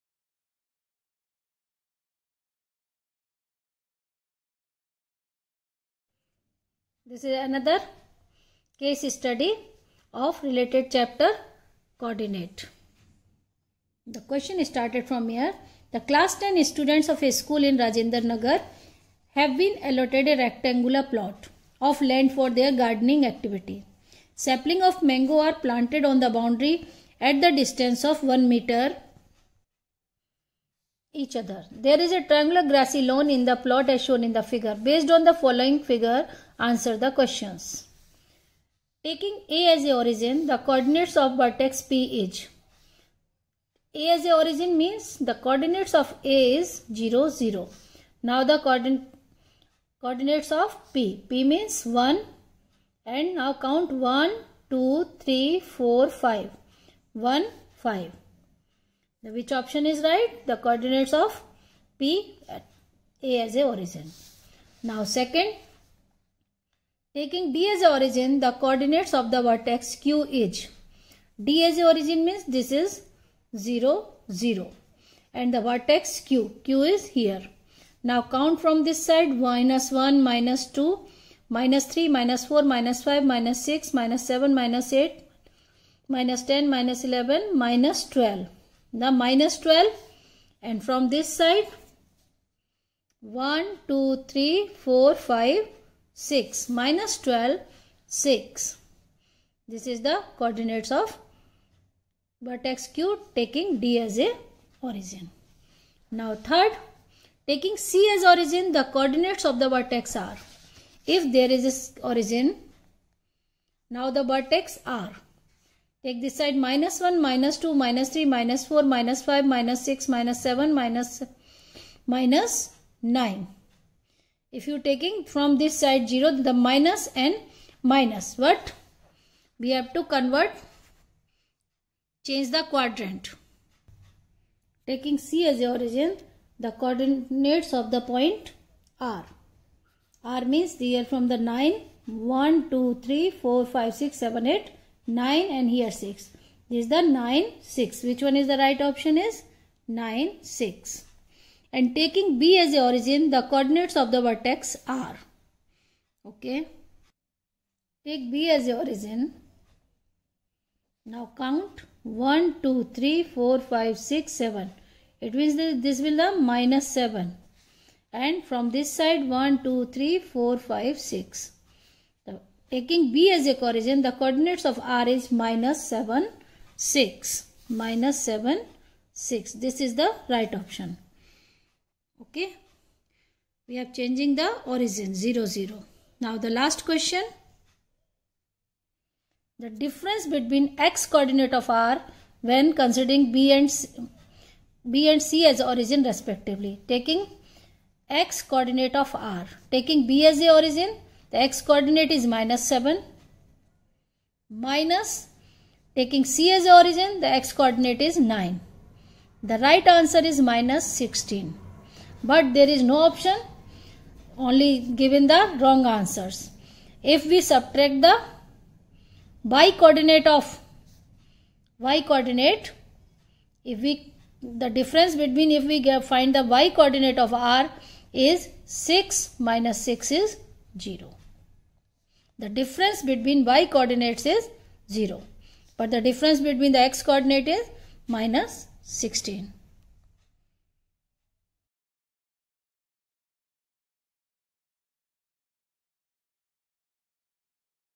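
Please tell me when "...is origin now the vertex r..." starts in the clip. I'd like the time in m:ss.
1:51.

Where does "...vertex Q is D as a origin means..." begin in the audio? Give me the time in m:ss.
1:09.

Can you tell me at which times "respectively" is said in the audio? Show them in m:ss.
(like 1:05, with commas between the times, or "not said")
3:16.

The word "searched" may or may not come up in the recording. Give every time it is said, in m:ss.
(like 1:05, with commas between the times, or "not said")
not said.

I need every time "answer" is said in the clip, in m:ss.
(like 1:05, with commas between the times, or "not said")
0:36, 3:29, 3:35.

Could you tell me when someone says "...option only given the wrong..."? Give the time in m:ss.
3:33.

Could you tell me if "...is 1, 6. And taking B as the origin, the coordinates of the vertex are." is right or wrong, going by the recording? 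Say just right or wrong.
wrong.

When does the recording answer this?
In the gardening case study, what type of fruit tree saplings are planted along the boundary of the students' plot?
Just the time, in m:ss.
0:25.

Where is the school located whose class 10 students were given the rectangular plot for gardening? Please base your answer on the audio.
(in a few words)
Rajendra Nagar.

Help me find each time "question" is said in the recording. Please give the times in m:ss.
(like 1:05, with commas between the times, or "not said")
0:14, 0:37, 3:06.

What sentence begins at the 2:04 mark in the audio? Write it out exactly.
If you taking from this side 0, the minus and minus.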